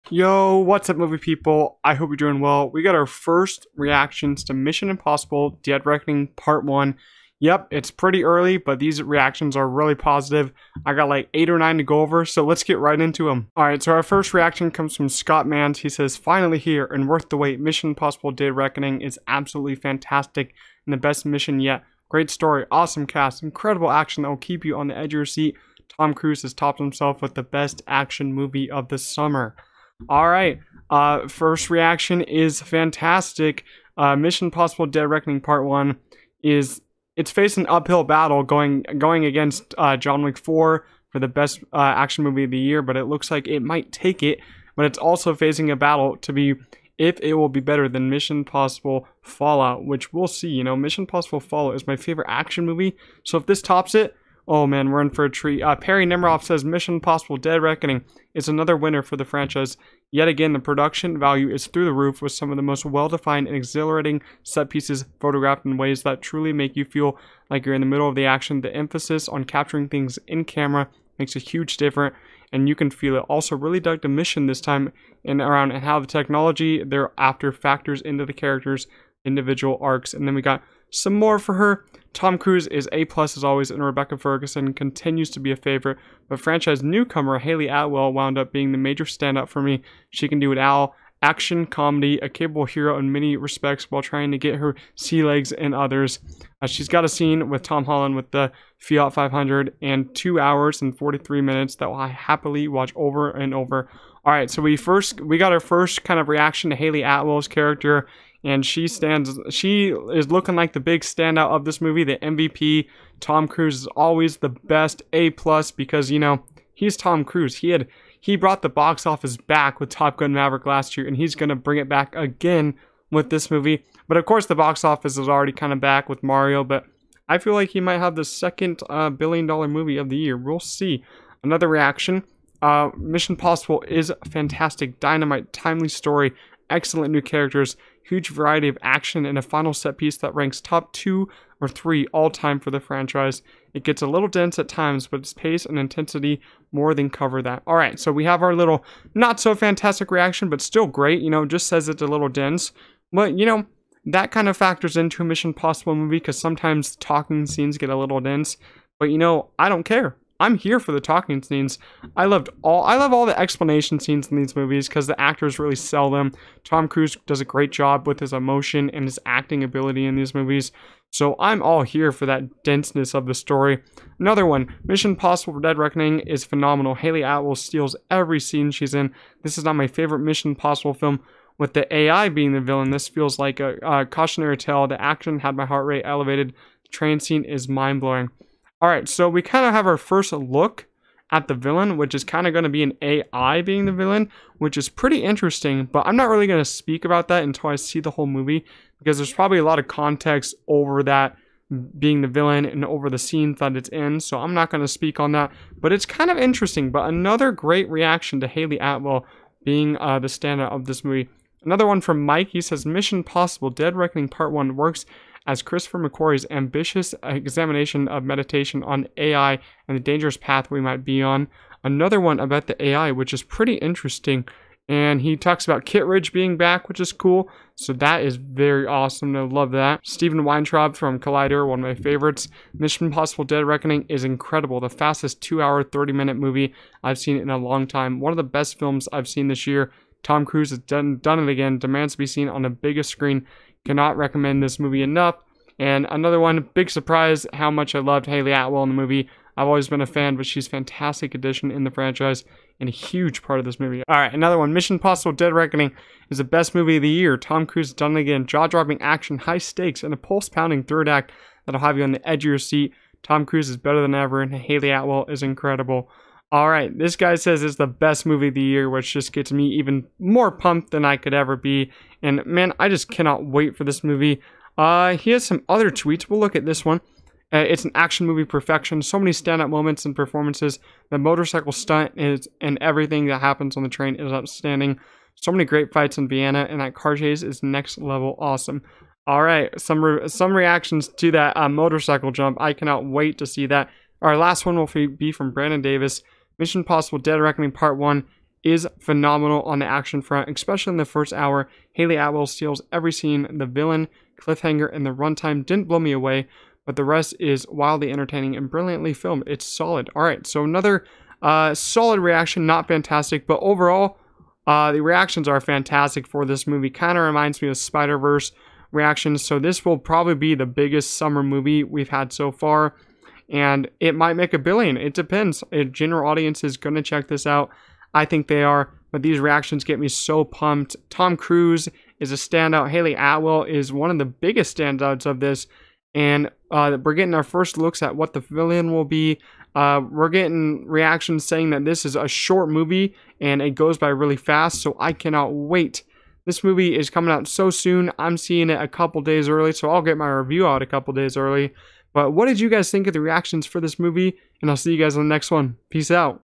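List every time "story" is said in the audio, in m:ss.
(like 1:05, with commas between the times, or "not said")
0:22, 2:15, 2:53.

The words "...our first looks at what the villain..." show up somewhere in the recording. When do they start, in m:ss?
5:37.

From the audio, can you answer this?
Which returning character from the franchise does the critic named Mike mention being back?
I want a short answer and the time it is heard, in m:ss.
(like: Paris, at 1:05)
Kittredge, at 3:45.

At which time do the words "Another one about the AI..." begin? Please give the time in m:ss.
3:41.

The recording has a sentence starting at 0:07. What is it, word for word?
Yep, it's pretty early, but these reactions are really positive.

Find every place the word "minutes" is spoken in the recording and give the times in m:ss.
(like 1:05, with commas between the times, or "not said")
1:41, 3:56.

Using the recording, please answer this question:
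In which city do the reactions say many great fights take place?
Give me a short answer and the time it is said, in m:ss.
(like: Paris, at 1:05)
Vienna, at 4:46.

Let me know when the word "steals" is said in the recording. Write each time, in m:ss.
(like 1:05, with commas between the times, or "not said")
2:57, 5:02.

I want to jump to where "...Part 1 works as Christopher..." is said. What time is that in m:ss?
3:34.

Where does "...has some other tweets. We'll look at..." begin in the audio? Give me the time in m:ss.
4:35.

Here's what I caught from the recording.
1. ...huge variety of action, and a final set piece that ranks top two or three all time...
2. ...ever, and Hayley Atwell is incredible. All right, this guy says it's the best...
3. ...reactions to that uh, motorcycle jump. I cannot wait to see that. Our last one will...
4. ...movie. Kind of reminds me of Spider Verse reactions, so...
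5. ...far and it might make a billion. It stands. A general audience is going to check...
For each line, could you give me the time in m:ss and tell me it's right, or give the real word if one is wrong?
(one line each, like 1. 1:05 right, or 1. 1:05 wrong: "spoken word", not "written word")
1. 2:18 right
2. 4:24 right
3. 4:50 right
4. 5:16 right
5. 5:22 wrong: "depends", not "stands".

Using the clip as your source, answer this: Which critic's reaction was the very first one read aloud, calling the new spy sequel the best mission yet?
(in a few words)
Scott Mans.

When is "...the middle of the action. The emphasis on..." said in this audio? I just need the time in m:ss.
1:07.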